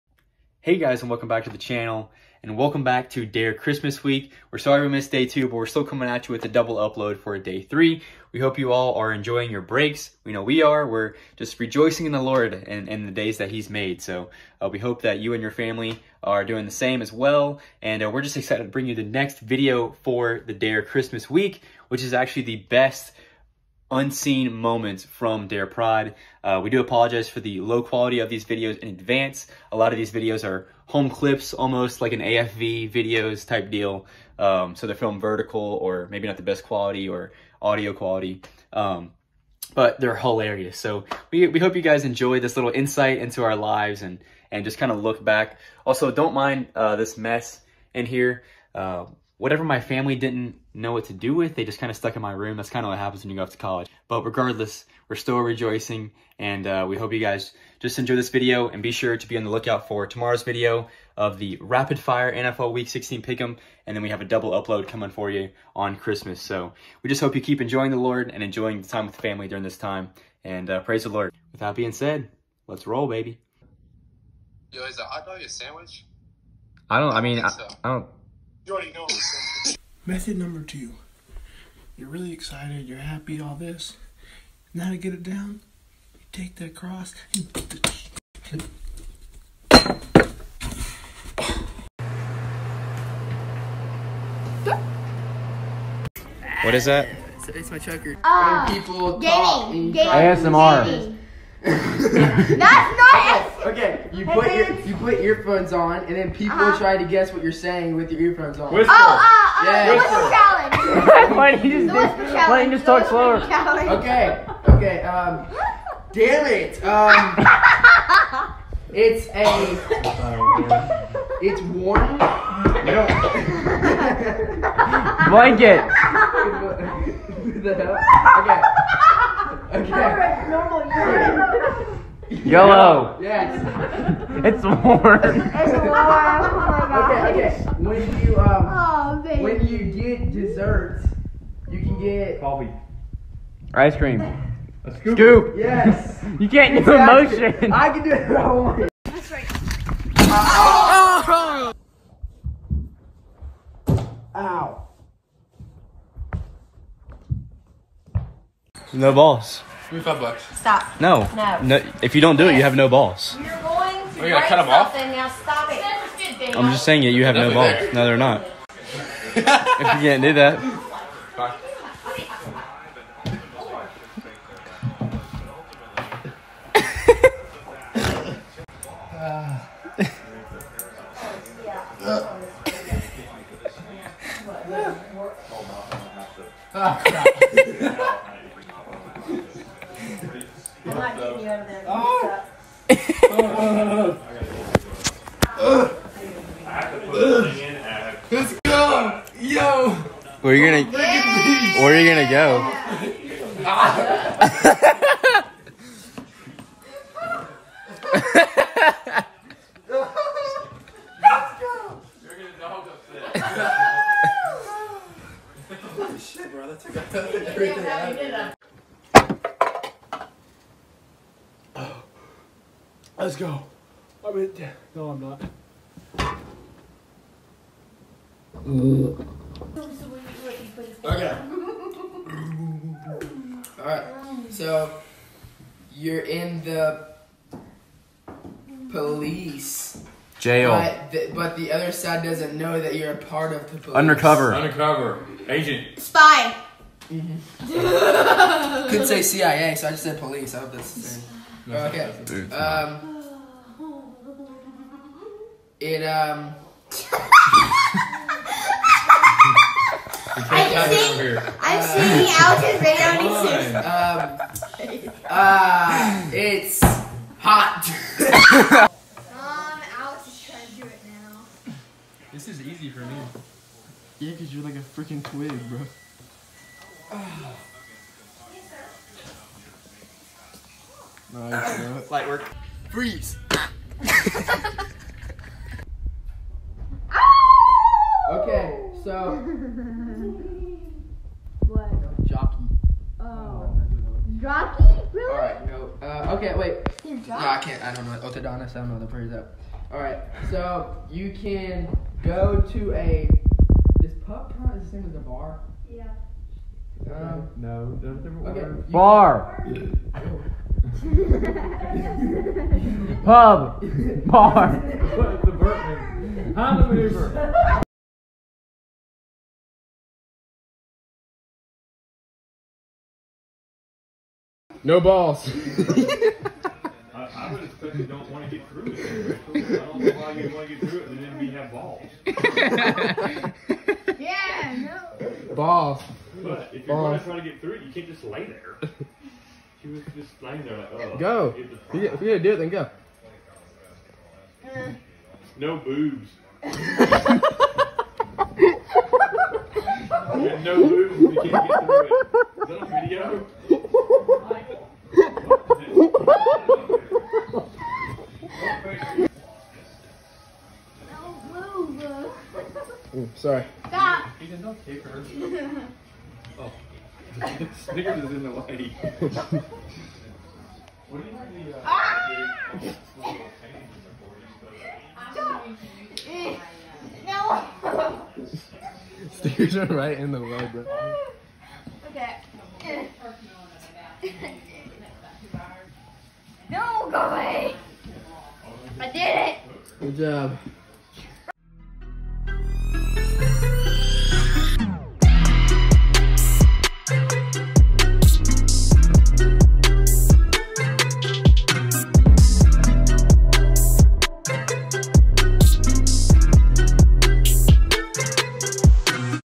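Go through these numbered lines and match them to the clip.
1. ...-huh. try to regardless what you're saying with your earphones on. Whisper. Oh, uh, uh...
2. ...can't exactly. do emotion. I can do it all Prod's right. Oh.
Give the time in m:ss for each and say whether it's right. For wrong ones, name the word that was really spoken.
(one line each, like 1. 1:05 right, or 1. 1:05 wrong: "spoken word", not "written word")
1. 1:46 wrong: "guess", not "regardless"
2. 2:26 wrong: "That", not "Prod".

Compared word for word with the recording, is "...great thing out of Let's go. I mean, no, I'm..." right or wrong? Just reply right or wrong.
right.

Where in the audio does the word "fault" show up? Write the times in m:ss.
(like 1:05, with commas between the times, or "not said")
not said.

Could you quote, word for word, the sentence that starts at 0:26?
Uh, we do apologize for the low quality of these videos in advance.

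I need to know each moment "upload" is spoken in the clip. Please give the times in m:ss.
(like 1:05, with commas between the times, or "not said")
0:06, 1:04.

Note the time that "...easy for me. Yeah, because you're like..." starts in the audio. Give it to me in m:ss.
4:32.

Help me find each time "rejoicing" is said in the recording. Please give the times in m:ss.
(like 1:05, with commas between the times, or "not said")
0:11, 0:55.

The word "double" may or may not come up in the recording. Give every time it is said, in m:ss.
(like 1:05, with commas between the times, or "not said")
0:06, 1:04.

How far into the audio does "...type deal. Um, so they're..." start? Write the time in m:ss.
0:33.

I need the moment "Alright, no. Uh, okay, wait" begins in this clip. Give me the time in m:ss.
4:55.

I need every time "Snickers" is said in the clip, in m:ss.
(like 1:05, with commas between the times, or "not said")
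6:07.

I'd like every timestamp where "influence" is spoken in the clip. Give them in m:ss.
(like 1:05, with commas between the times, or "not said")
not said.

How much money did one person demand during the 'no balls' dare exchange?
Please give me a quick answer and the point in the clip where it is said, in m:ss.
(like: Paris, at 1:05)
5 bucks, at 2:40.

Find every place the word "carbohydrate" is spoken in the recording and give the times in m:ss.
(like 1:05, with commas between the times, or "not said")
not said.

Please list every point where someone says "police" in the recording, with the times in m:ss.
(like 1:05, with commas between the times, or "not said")
3:58, 4:03, 4:10.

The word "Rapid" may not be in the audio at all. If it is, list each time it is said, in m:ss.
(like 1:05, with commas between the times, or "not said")
1:01.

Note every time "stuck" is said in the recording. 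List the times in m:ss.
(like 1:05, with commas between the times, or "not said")
0:51.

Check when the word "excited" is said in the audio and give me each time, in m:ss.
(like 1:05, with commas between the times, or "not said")
0:18, 1:22.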